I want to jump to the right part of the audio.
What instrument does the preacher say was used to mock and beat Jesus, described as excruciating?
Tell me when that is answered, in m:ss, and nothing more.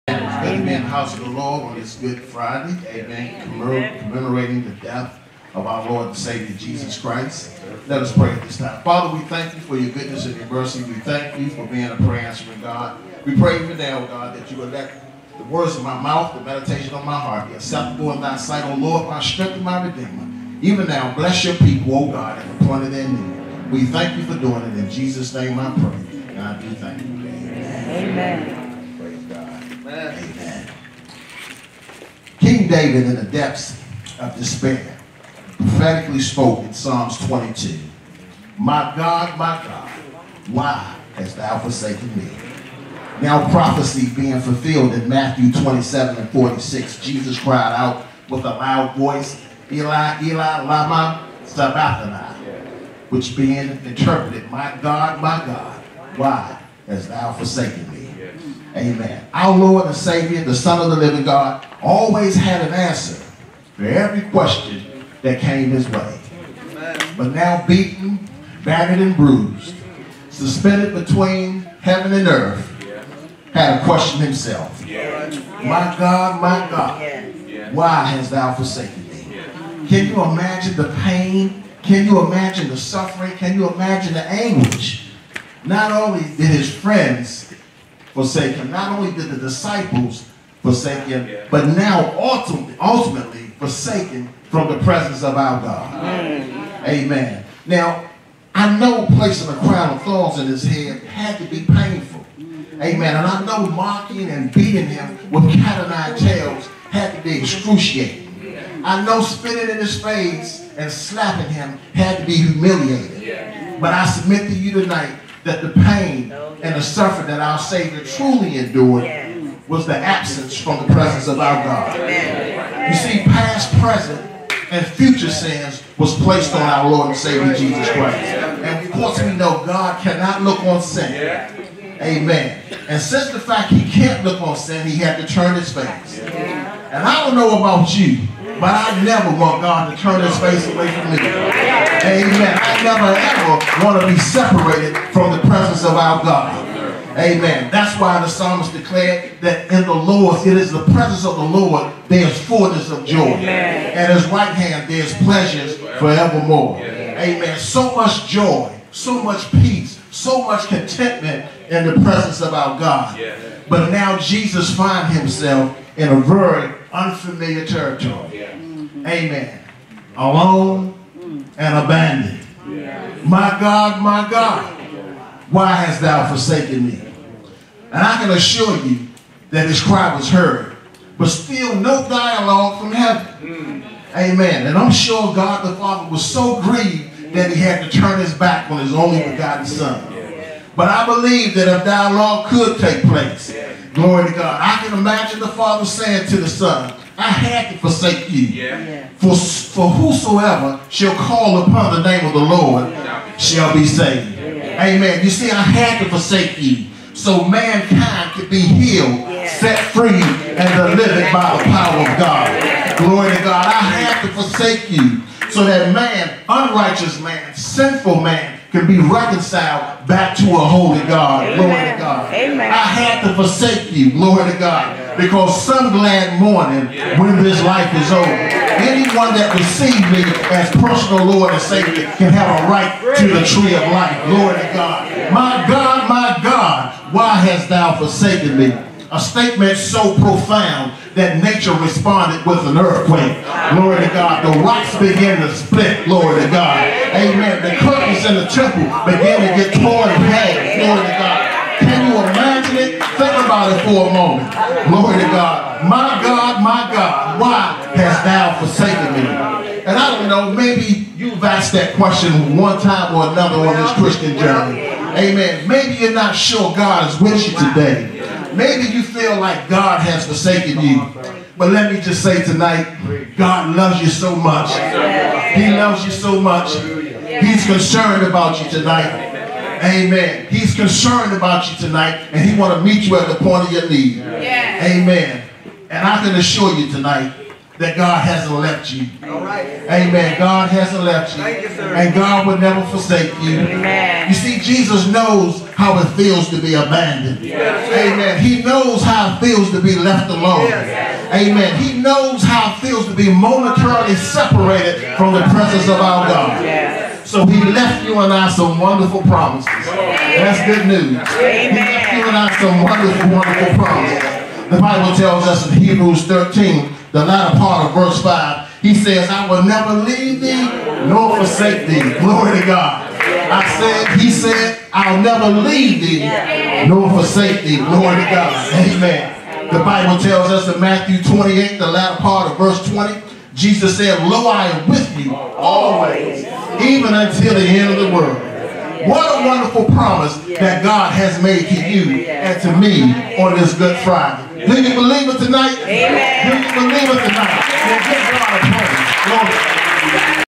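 1:45.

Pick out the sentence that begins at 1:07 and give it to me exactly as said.
But now beaten, battered and bruised, suspended between heaven and earth, had a question himself.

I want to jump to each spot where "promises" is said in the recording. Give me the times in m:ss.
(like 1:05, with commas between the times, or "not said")
5:09, 5:13, 5:39.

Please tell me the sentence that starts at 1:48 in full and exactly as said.
I know spitting in his face and slapping him had to be humiliating.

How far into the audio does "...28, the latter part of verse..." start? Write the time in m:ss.
5:31.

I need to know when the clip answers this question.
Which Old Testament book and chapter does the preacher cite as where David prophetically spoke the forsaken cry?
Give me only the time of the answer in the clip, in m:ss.
0:36.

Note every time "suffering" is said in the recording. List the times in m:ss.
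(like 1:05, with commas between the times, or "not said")
1:22, 1:56.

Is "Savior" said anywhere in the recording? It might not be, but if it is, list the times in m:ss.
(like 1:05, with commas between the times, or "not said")
0:06, 0:59, 1:57, 2:07, 3:51.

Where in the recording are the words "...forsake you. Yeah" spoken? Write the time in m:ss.
3:17.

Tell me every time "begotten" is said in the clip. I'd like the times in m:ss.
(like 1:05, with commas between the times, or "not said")
3:09.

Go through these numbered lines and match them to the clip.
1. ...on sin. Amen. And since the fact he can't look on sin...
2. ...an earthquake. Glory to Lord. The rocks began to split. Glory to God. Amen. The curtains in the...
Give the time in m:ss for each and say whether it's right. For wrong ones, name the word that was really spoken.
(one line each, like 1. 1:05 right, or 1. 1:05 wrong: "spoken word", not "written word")
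1. 2:10 right
2. 4:02 wrong: "God", not "Lord".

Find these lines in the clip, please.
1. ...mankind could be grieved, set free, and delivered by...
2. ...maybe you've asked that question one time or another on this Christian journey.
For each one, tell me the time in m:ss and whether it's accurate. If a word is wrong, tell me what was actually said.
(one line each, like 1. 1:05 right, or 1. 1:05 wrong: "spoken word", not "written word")
1. 3:27 wrong: "healed", not "grieved"
2. 4:20 right.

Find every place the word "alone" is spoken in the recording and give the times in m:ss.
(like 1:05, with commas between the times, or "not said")
2:50, 5:00.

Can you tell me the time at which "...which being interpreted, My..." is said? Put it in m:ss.
0:53.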